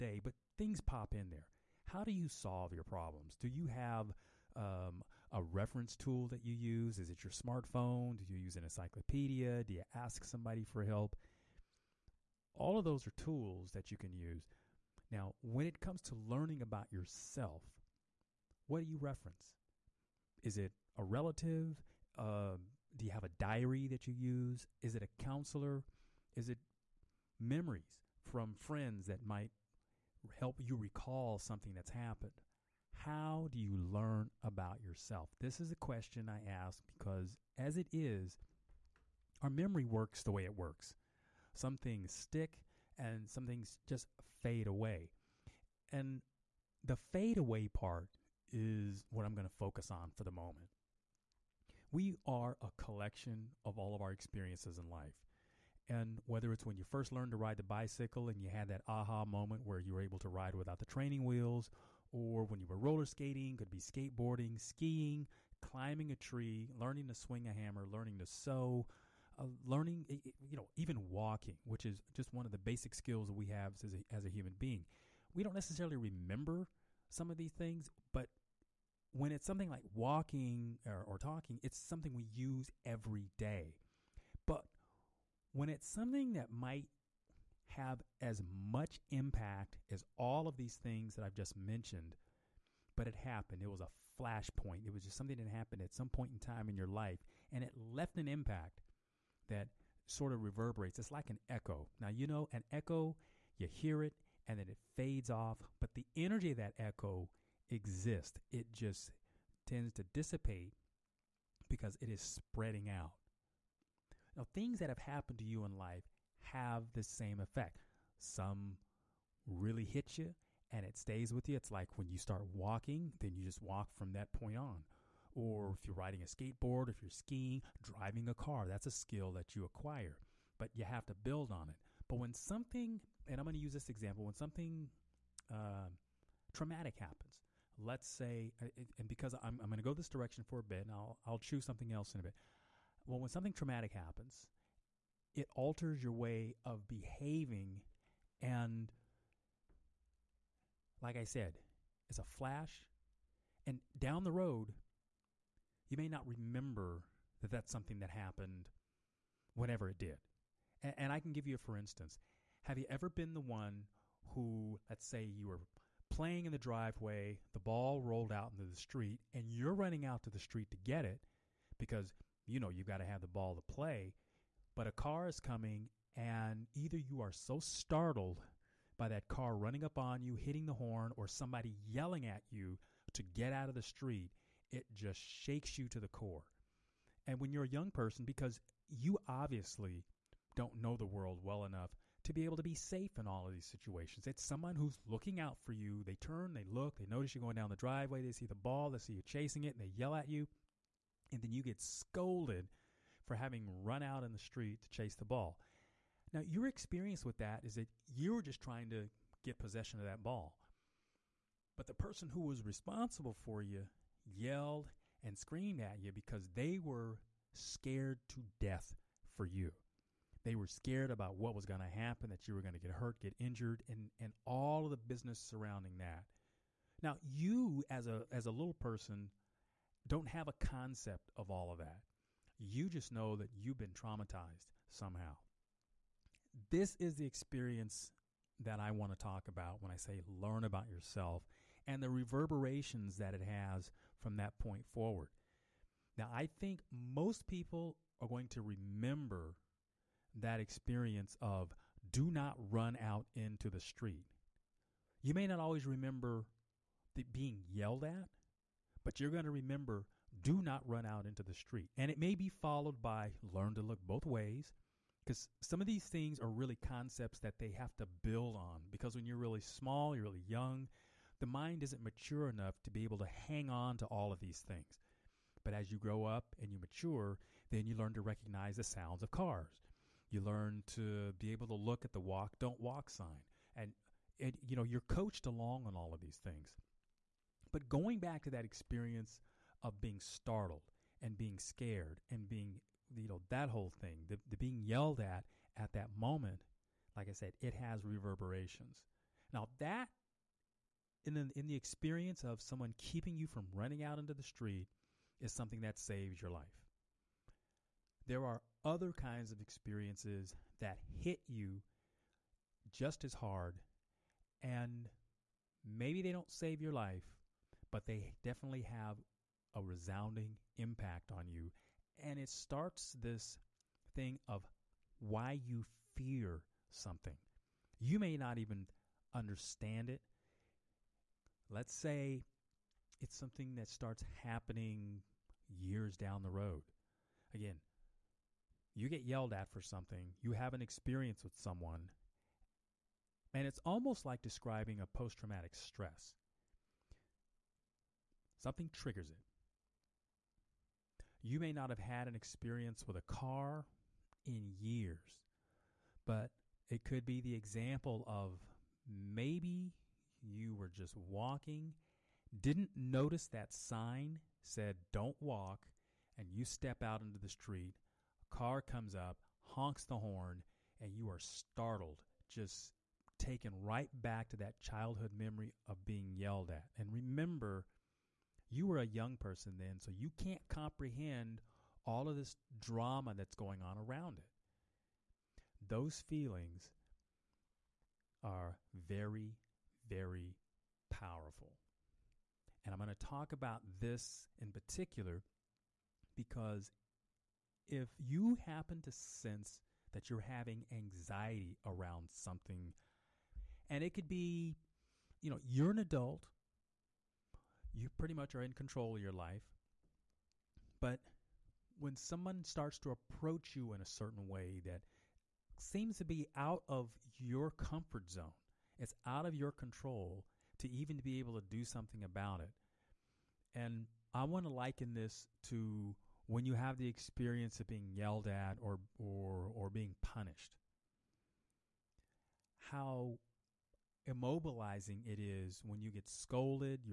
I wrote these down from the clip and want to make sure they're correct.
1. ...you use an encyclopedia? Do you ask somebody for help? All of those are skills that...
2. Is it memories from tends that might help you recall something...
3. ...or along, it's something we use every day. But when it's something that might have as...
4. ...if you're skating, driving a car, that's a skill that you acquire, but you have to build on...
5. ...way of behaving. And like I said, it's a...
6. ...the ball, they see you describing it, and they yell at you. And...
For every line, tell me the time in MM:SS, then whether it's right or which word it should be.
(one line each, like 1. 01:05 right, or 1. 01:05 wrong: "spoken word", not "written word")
1. 00:08 wrong: "tools", not "skills"
2. 00:26 wrong: "friends", not "tends"
3. 01:21 wrong: "talking", not "along"
4. 02:06 wrong: "skiing", not "skating"
5. 02:26 right
6. 03:18 wrong: "chasing", not "describing".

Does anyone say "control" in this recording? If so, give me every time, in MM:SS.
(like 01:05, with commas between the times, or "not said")
06:48, 06:59.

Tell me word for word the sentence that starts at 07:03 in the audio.
And I want to liken this to when you have the experience of being yelled at or or or being punished.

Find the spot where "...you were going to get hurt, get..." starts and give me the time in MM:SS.
03:42.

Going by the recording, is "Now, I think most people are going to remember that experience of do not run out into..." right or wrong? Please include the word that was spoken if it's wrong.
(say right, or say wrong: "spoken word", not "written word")
right.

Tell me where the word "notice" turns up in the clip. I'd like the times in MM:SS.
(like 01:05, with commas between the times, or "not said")
03:17, 06:02.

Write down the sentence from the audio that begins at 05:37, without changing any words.
Again, you get yelled at for something, you have an experience with someone, and it's almost like describing a post traumatic stress.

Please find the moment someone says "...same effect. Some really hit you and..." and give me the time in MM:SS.
01:57.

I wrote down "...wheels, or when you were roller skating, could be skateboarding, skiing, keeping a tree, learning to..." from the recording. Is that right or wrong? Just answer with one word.
wrong.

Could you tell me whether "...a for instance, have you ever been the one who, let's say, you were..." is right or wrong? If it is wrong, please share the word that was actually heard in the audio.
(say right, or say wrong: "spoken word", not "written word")
right.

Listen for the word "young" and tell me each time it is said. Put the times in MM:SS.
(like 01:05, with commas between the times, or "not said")
03:07, 04:30, 06:19.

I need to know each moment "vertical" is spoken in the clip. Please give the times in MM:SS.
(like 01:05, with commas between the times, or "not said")
not said.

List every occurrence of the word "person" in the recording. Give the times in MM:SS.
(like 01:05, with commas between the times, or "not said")
03:07, 03:31, 03:48, 06:19.